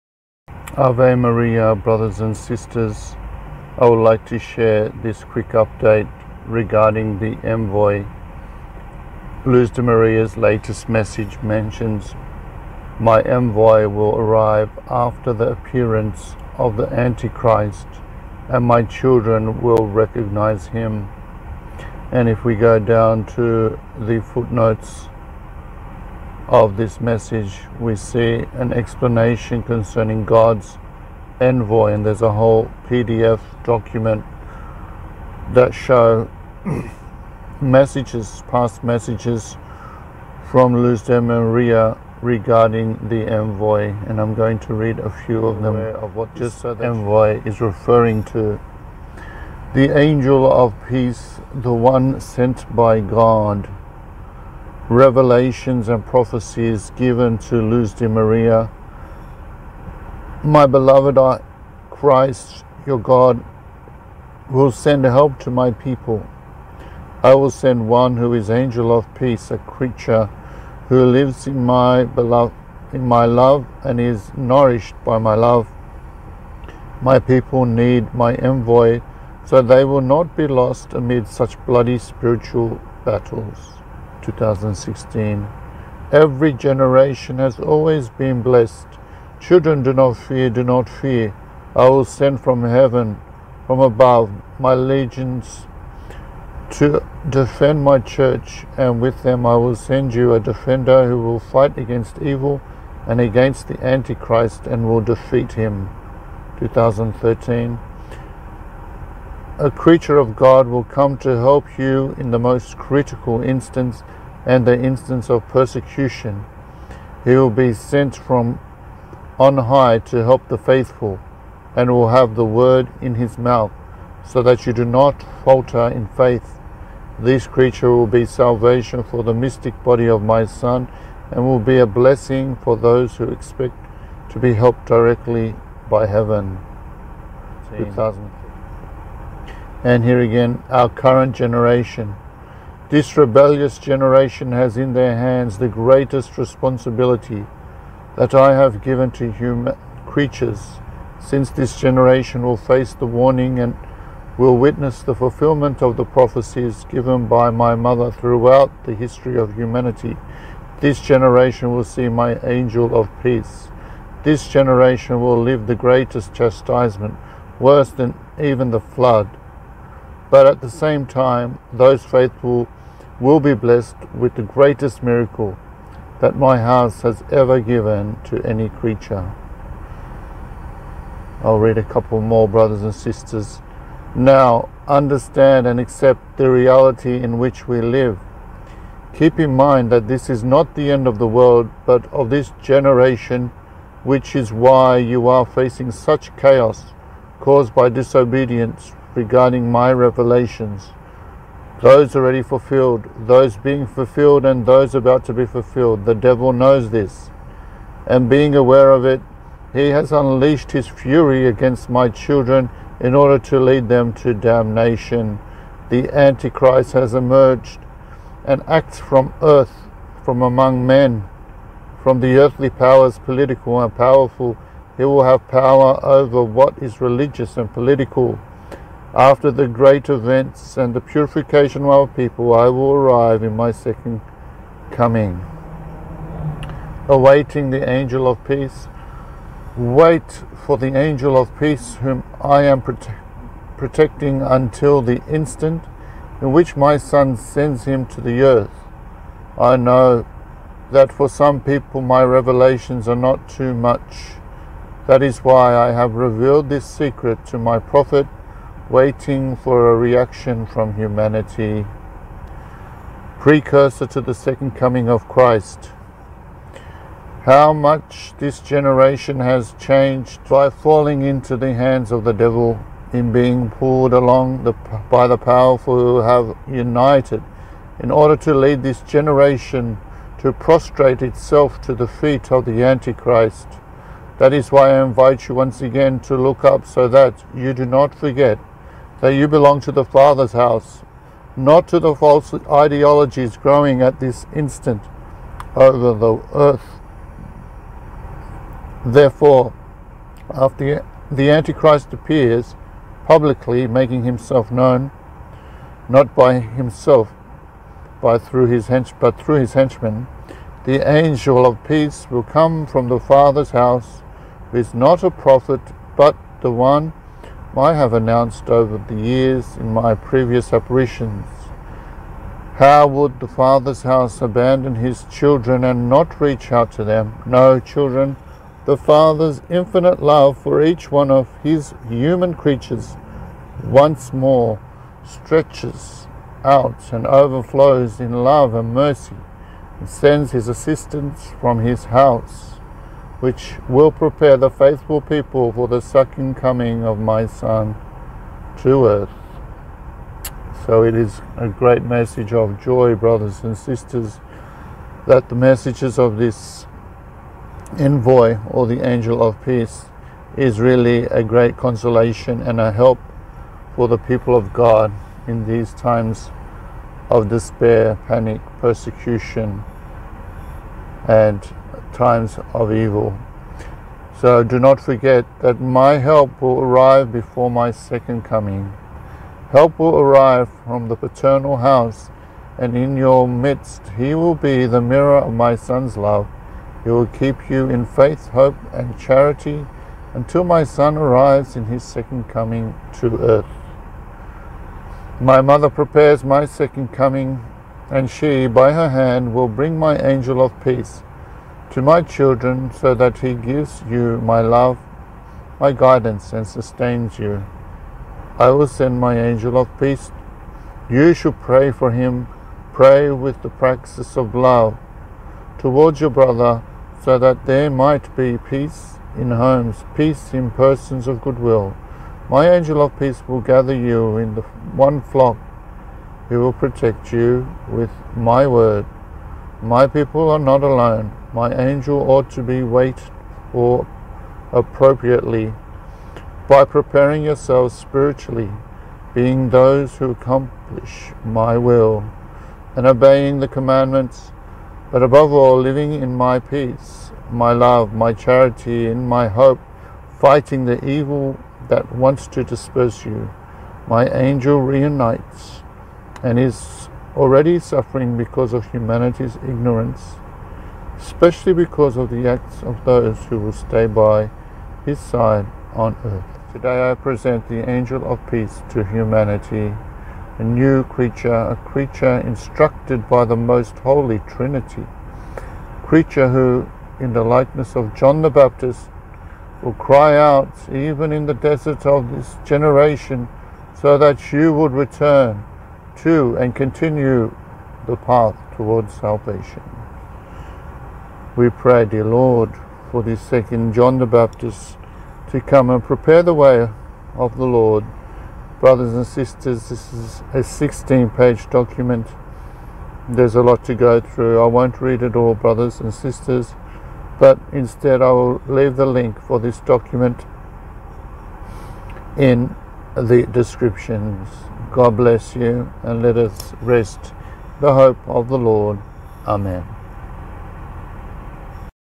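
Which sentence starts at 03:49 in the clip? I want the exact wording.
After the great events and the purification of our people, I will arrive in my second coming.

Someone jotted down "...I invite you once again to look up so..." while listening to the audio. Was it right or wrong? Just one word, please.
right.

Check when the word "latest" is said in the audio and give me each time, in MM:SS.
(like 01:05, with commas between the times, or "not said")
00:10.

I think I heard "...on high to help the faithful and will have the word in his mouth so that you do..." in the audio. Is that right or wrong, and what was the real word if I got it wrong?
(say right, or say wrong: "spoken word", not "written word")
right.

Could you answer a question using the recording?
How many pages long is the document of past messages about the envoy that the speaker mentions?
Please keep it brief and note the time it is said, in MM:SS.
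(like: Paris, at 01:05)
16, at 08:20.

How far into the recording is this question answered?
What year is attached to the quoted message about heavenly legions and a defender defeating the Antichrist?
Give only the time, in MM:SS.
01:46.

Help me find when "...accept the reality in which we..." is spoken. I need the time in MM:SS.
03:05.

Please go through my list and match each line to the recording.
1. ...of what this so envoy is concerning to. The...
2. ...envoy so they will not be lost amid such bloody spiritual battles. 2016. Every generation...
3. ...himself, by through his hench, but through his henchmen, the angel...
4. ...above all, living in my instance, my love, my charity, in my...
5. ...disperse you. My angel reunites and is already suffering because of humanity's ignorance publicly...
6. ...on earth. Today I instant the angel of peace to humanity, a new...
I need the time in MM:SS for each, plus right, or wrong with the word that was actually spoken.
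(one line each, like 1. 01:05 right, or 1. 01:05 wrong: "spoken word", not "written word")
1. 00:45 wrong: "referring", not "concerning"
2. 01:18 right
3. 05:06 right
4. 07:25 wrong: "peace", not "instance"
5. 07:32 wrong: "especially", not "publicly"
6. 07:45 wrong: "present", not "instant".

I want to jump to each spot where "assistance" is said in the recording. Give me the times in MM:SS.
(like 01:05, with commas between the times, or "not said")
05:40.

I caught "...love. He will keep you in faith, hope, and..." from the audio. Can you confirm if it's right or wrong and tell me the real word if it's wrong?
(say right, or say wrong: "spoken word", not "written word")
right.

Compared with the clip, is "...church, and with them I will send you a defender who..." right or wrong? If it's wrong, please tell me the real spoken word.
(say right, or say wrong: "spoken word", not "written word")
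right.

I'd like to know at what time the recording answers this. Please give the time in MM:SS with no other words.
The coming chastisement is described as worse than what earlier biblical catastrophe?
02:48.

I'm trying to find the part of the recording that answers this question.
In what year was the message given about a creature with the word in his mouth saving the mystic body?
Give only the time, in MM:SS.
02:17.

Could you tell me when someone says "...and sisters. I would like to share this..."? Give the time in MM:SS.
00:02.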